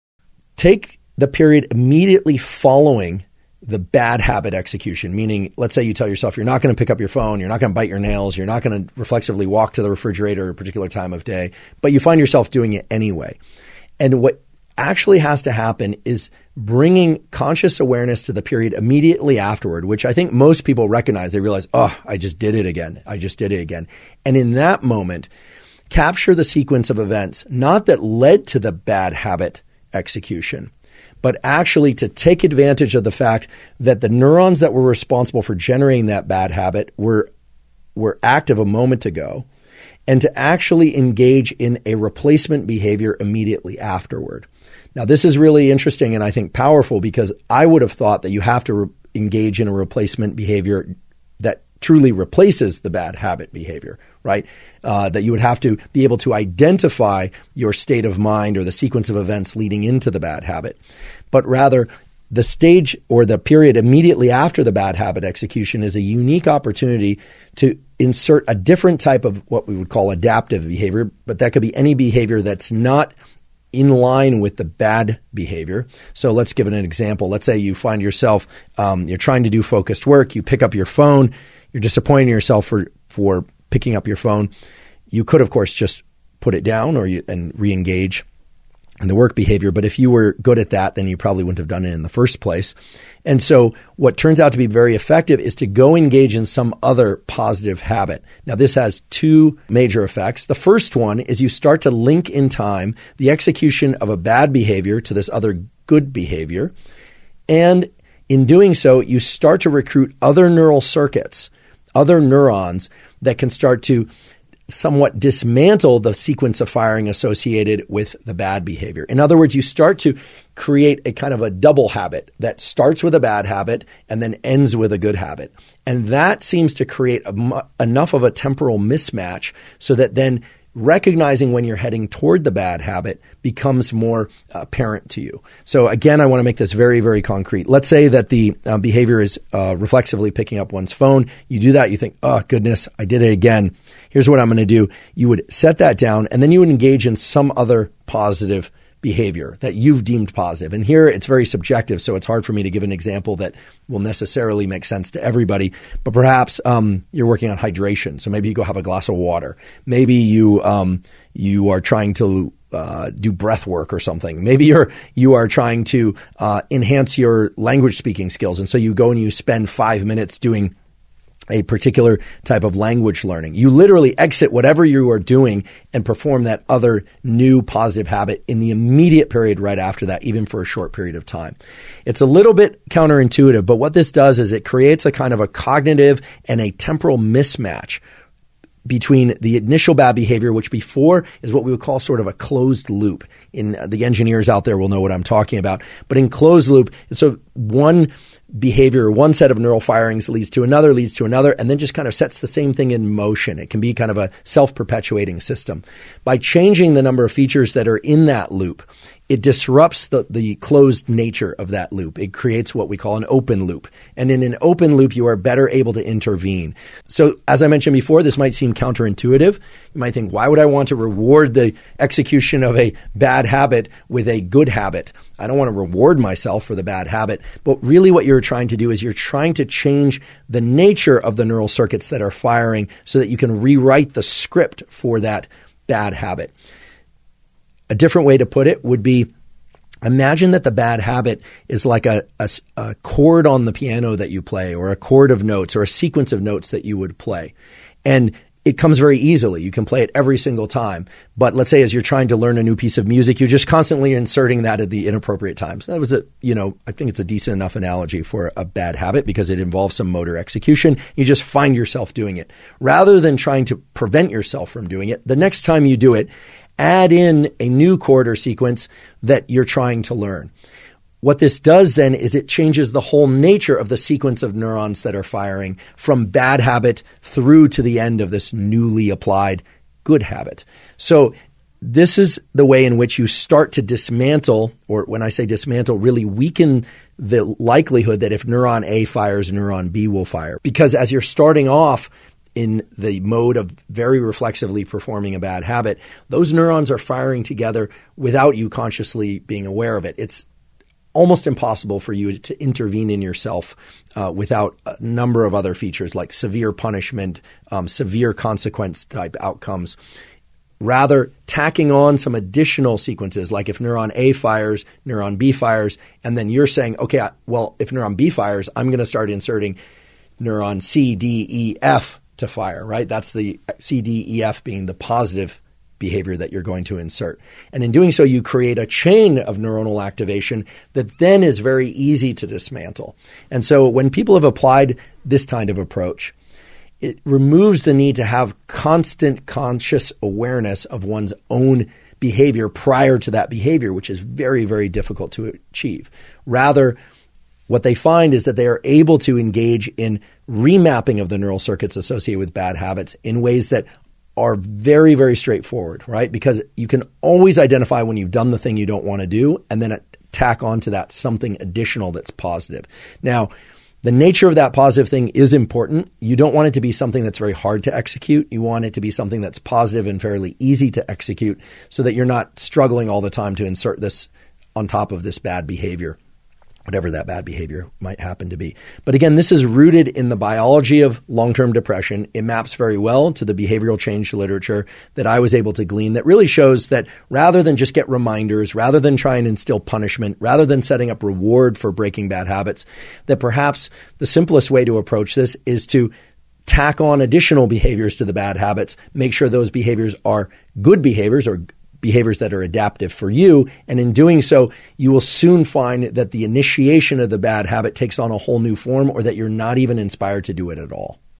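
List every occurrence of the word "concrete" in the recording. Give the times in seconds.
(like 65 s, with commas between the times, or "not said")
137 s.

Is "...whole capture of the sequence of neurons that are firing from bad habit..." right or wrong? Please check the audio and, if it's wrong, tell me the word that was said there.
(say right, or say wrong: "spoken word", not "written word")
wrong: "nature", not "capture".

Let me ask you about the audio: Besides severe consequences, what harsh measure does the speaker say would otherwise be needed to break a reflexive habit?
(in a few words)
severe punishment.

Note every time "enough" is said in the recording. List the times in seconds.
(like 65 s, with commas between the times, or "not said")
127 s, 257 s.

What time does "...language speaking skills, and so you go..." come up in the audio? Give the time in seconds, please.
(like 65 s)
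167 s.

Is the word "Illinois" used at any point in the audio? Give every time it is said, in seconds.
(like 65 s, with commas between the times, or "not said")
not said.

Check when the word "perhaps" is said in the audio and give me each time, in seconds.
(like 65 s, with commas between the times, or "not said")
156 s, 393 s.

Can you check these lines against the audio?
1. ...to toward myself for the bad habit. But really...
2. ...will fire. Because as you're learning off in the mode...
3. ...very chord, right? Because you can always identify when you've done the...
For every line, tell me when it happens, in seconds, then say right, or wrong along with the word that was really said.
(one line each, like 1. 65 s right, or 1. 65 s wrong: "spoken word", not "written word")
1. 225 s wrong: "reward", not "toward"
2. 290 s wrong: "starting", not "learning"
3. 355 s wrong: "straightforward", not "chord".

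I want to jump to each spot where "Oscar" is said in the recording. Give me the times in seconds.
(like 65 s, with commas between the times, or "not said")
not said.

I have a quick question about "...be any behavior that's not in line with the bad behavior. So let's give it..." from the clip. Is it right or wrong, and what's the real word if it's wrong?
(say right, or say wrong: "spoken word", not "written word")
right.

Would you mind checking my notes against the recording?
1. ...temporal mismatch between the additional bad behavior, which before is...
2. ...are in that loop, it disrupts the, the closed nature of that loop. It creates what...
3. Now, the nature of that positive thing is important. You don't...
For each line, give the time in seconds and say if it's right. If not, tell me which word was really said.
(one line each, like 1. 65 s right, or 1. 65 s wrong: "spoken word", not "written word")
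1. 186 s wrong: "initial", not "additional"
2. 207 s right
3. 363 s right.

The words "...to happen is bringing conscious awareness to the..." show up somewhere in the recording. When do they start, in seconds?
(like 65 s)
15 s.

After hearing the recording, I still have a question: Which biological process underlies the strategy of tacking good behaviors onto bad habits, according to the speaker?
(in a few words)
long term depression.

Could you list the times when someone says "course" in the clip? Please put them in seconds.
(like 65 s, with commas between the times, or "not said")
85 s.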